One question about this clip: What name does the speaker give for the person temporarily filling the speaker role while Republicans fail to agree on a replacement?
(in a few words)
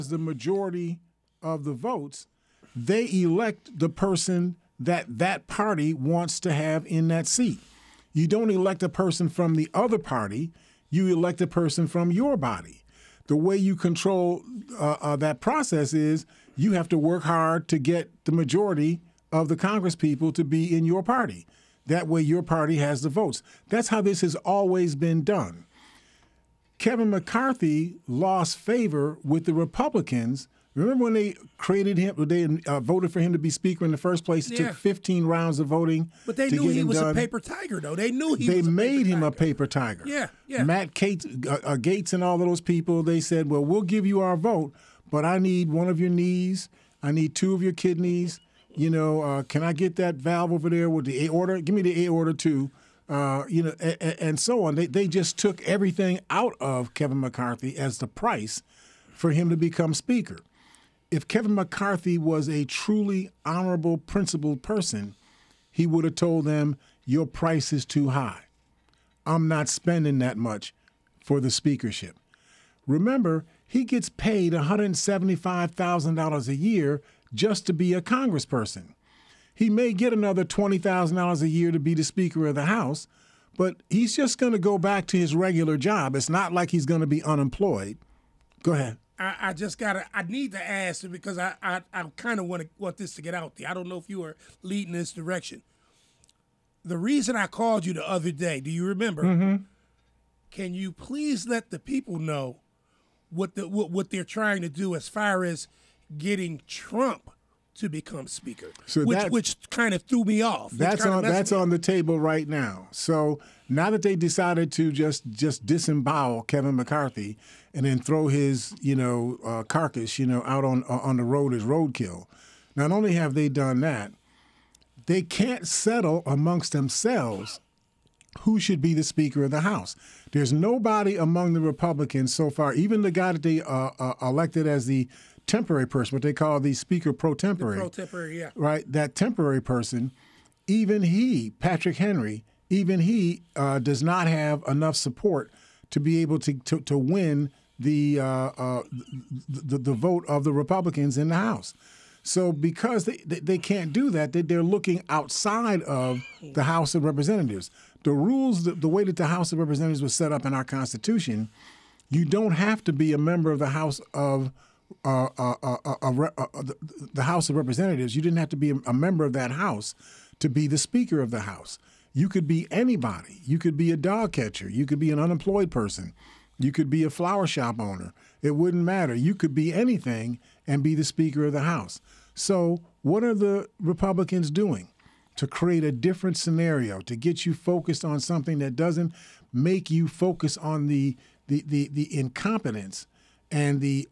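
Patrick Henry.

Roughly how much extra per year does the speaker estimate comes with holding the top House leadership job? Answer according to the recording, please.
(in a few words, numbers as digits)
$20,000.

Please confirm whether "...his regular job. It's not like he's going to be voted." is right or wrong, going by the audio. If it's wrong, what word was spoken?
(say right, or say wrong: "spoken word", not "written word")
wrong: "unemployed", not "voted".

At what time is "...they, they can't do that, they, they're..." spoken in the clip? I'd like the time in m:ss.
2:33.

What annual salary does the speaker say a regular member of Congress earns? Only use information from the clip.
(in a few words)
$175,000.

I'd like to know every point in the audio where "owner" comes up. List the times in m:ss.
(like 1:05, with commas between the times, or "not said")
2:57.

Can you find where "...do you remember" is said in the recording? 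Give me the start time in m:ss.
1:38.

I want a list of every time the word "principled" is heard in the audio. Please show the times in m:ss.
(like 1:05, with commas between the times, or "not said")
1:03.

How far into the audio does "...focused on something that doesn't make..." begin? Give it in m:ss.
3:07.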